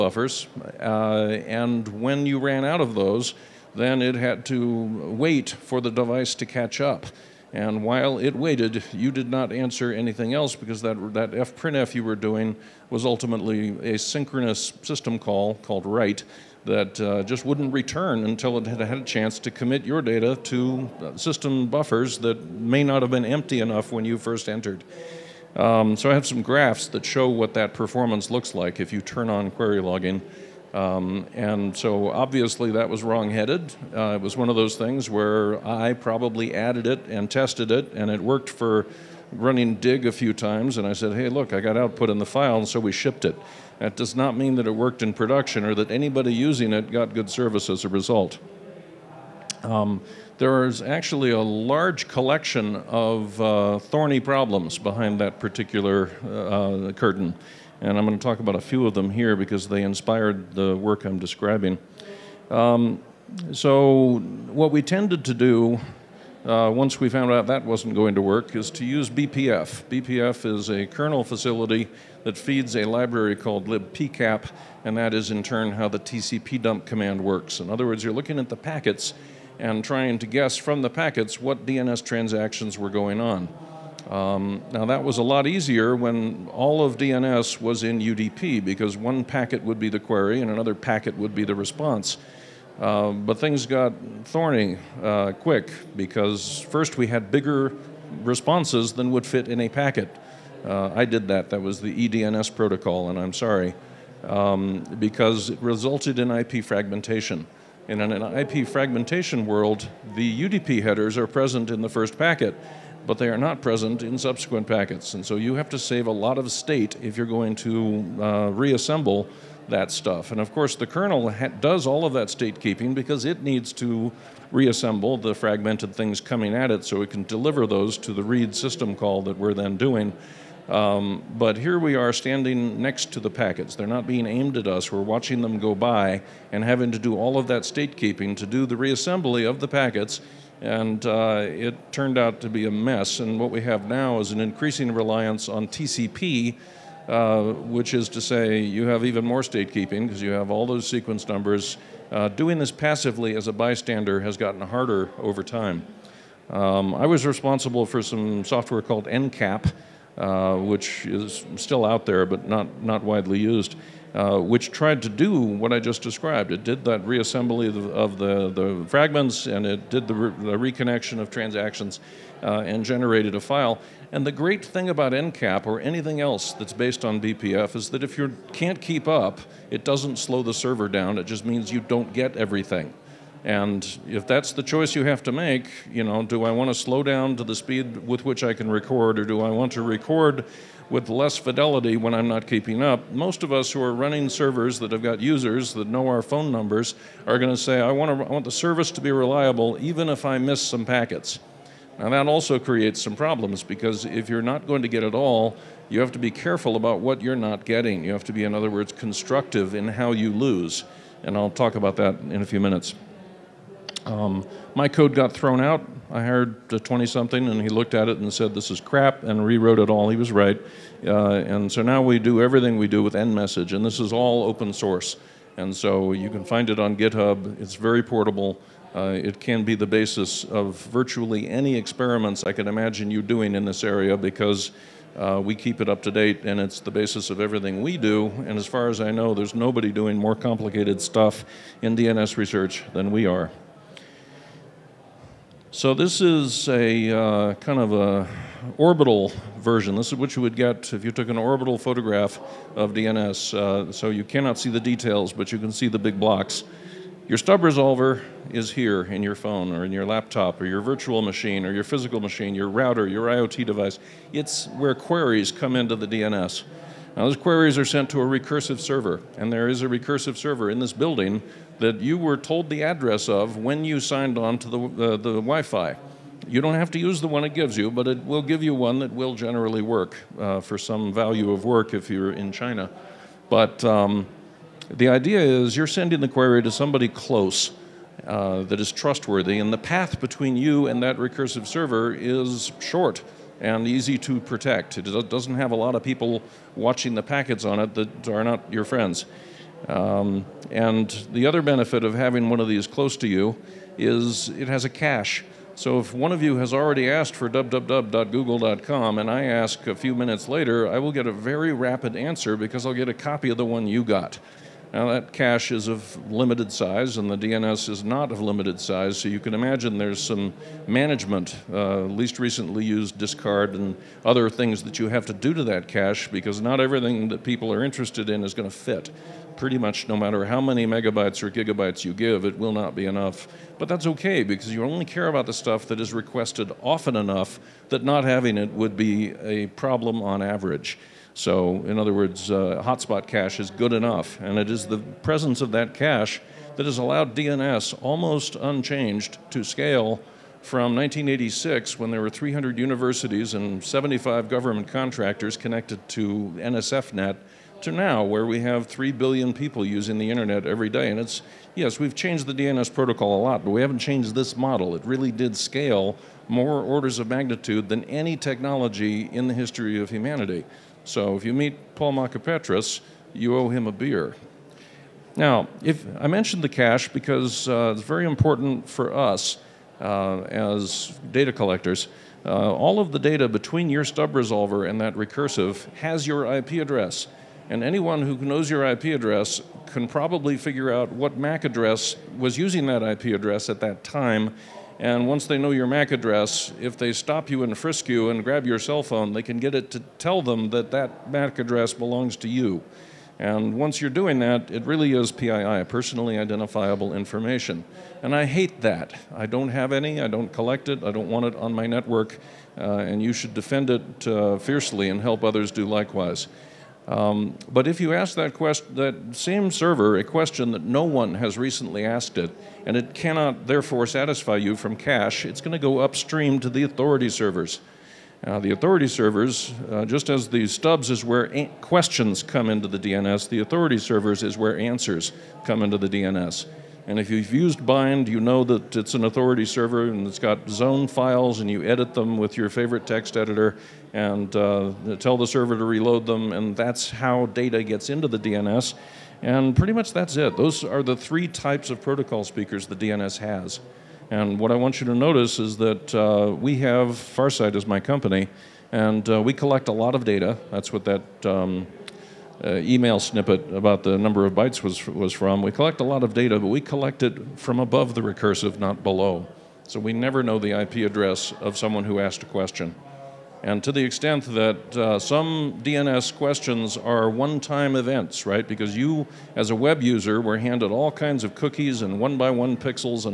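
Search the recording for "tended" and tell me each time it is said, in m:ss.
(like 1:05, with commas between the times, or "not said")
1:04.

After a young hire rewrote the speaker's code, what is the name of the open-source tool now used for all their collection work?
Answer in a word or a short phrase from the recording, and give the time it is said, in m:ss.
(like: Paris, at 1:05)
nMessage, at 3:43.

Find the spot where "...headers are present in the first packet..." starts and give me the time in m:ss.
1:50.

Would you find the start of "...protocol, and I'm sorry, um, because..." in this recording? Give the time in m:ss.
1:42.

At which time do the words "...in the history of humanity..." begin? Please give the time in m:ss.
6:09.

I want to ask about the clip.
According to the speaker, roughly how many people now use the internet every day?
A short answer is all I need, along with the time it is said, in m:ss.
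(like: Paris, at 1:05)
3 billion, at 5:58.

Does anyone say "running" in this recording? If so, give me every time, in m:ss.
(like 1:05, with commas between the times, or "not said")
0:39, 3:13.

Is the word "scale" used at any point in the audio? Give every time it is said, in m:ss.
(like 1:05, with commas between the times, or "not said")
5:49, 6:05.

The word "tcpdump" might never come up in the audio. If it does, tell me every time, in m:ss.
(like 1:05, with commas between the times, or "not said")
1:15.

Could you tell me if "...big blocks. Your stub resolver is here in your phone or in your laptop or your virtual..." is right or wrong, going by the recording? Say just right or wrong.
right.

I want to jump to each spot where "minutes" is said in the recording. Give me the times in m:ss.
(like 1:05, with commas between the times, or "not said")
3:32, 5:10.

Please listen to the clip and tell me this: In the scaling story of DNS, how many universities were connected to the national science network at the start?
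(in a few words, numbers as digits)
300.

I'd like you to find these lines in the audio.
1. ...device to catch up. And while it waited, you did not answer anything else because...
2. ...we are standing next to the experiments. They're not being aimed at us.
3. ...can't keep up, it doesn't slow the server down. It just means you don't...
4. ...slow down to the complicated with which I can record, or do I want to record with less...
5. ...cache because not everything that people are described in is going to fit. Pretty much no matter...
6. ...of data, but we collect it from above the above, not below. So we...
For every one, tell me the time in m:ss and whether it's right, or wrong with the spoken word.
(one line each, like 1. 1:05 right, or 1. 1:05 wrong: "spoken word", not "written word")
1. 0:05 right
2. 2:11 wrong: "packets", not "experiments"
3. 2:58 right
4. 3:06 wrong: "speed", not "complicated"
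5. 5:25 wrong: "interested", not "described"
6. 7:46 wrong: "recursive", not "above".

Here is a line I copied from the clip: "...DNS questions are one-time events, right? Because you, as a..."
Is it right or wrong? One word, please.
right.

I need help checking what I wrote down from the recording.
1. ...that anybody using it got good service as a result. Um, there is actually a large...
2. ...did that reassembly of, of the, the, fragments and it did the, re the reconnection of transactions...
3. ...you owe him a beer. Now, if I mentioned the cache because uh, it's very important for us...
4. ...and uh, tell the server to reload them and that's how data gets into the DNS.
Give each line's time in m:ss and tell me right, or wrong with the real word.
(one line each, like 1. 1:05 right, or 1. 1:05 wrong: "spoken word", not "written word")
1. 0:45 right
2. 2:46 right
3. 6:13 right
4. 7:24 right.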